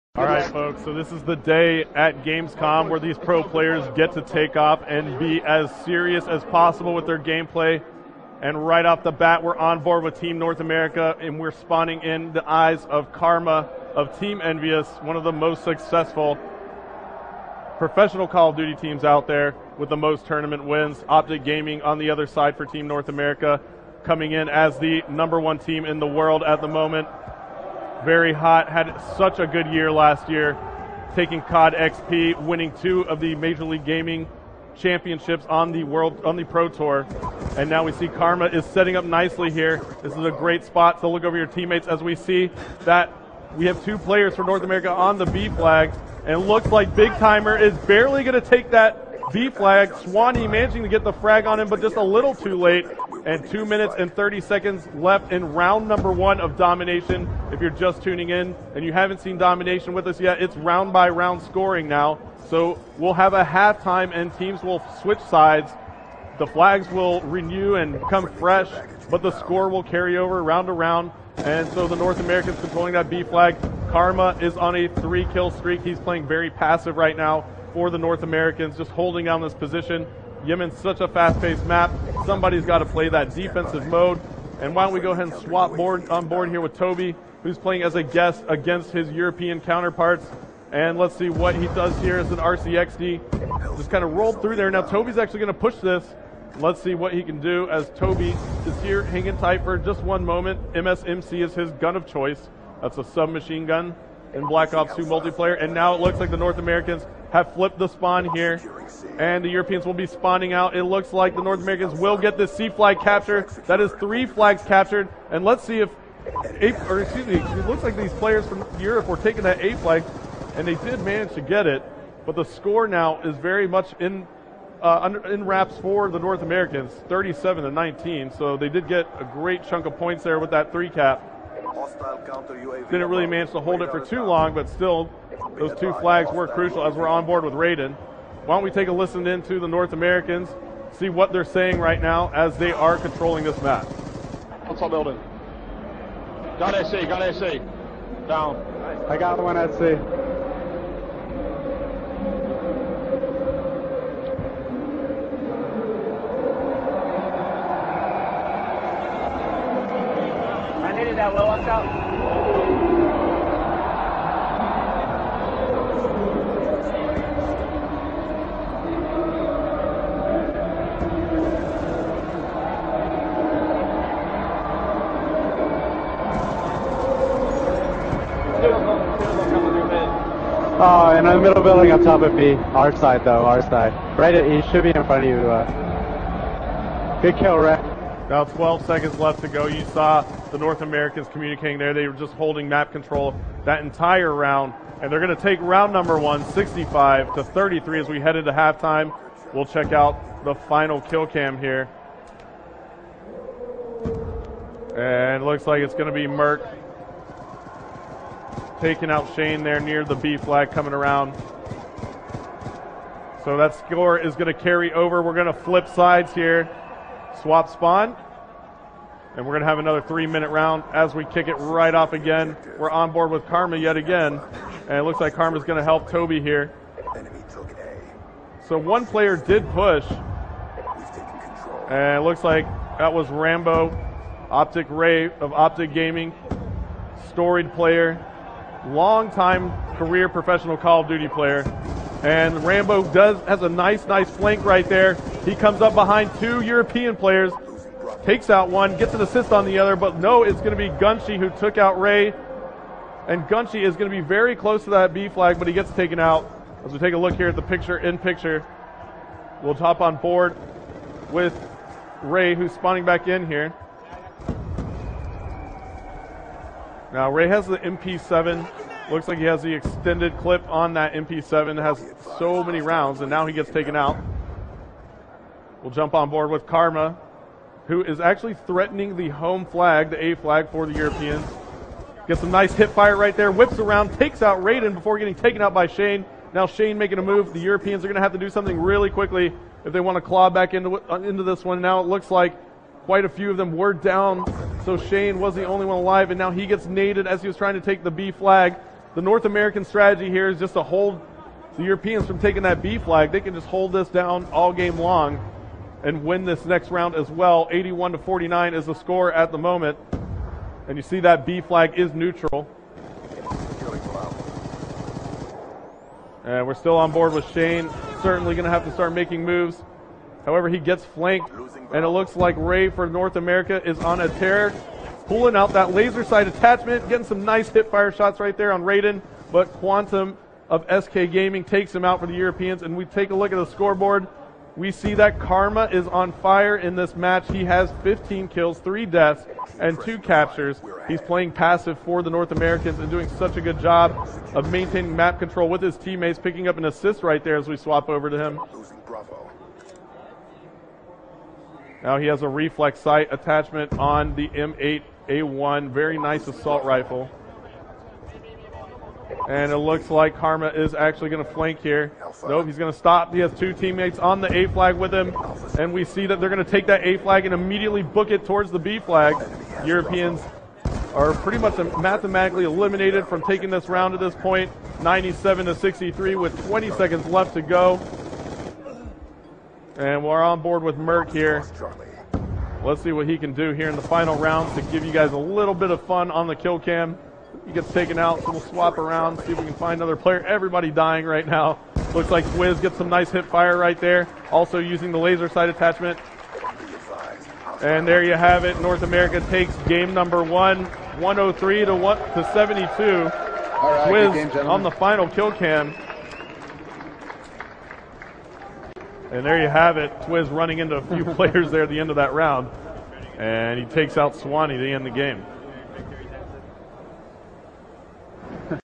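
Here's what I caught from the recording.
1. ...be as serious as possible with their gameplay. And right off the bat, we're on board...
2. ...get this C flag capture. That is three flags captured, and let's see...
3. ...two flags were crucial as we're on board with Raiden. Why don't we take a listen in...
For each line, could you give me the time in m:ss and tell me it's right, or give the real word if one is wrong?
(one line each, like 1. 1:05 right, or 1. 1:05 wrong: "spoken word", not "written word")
1. 0:05 right
2. 1:52 right
3. 2:15 right.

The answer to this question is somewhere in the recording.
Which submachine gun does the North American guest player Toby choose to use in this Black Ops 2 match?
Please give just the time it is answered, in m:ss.
1:40.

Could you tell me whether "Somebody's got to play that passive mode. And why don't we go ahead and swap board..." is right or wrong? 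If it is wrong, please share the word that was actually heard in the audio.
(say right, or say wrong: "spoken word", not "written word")
wrong: "defensive", not "passive".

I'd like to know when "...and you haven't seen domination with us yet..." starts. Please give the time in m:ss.
0:58.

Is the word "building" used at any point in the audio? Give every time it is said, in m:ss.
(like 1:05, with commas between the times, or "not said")
2:24, 3:01.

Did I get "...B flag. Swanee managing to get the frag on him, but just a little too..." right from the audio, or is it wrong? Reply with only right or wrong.
right.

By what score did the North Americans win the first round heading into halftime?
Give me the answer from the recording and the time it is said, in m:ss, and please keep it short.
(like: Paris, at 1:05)
65 to 33, at 3:16.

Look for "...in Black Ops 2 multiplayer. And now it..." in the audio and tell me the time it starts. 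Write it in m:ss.
1:44.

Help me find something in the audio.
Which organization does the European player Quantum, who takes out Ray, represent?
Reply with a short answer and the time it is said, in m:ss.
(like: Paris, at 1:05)
SK Gaming, at 5:31.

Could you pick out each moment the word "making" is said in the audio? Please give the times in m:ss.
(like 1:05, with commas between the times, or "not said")
4:46, 5:19.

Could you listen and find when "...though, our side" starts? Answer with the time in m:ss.
3:03.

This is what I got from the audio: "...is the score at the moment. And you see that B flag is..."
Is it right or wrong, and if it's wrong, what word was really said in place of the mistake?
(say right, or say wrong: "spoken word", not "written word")
right.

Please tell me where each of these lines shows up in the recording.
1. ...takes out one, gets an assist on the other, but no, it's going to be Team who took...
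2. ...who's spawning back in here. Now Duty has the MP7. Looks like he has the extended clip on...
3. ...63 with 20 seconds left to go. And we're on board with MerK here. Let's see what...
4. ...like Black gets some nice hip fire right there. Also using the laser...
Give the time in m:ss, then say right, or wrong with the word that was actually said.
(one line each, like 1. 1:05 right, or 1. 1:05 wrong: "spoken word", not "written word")
1. 4:08 wrong: "Gunshi", not "Team"
2. 4:22 wrong: "Ray", not "Duty"
3. 6:15 right
4. 6:32 wrong: "Wiz", not "Black".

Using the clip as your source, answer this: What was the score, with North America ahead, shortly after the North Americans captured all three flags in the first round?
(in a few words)
37 to 19.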